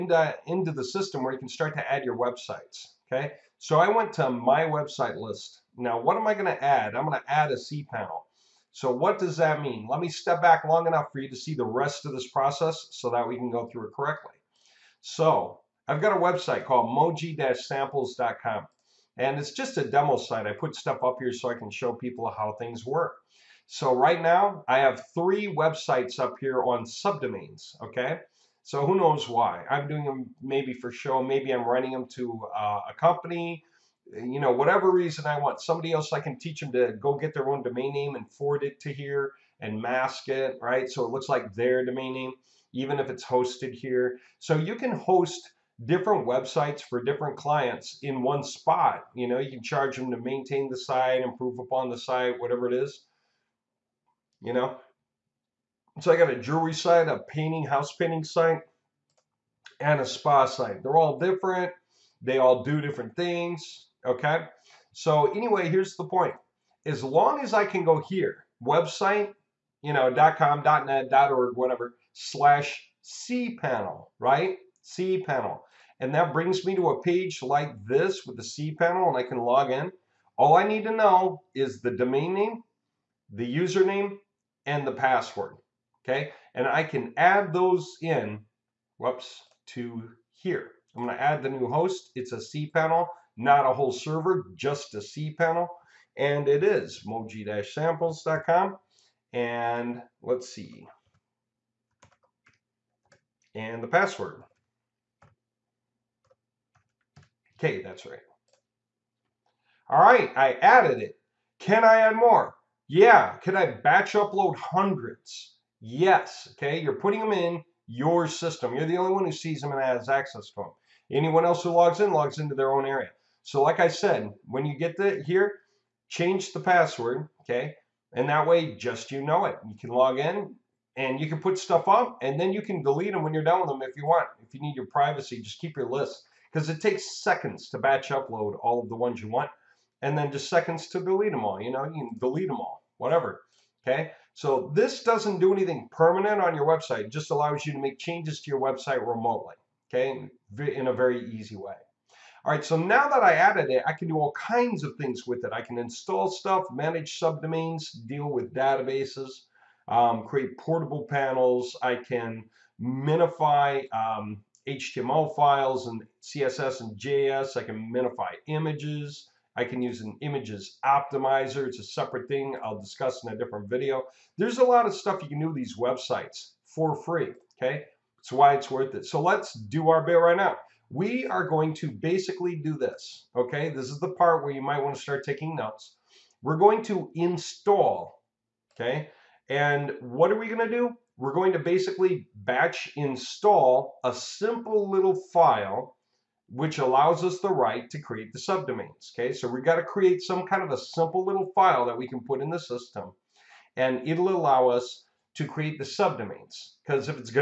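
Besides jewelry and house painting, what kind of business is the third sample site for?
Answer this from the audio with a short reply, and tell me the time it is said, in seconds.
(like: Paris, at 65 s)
spa, at 60 s.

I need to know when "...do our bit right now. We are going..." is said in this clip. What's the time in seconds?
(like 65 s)
179 s.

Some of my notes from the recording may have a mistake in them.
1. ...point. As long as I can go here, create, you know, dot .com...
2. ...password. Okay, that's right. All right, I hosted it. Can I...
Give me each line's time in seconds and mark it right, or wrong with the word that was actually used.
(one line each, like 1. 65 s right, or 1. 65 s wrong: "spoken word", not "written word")
1. 66 s wrong: "website", not "create"
2. 103 s wrong: "added", not "hosted".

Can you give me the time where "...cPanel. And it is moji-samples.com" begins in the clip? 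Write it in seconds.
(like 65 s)
94 s.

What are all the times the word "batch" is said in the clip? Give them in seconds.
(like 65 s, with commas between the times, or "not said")
113 s, 137 s, 192 s.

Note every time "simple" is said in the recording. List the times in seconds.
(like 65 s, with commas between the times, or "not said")
194 s, 200 s.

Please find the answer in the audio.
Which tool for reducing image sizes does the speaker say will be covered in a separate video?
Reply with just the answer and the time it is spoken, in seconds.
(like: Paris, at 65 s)
images optimizer, at 170 s.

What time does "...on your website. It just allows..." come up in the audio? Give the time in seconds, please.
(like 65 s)
146 s.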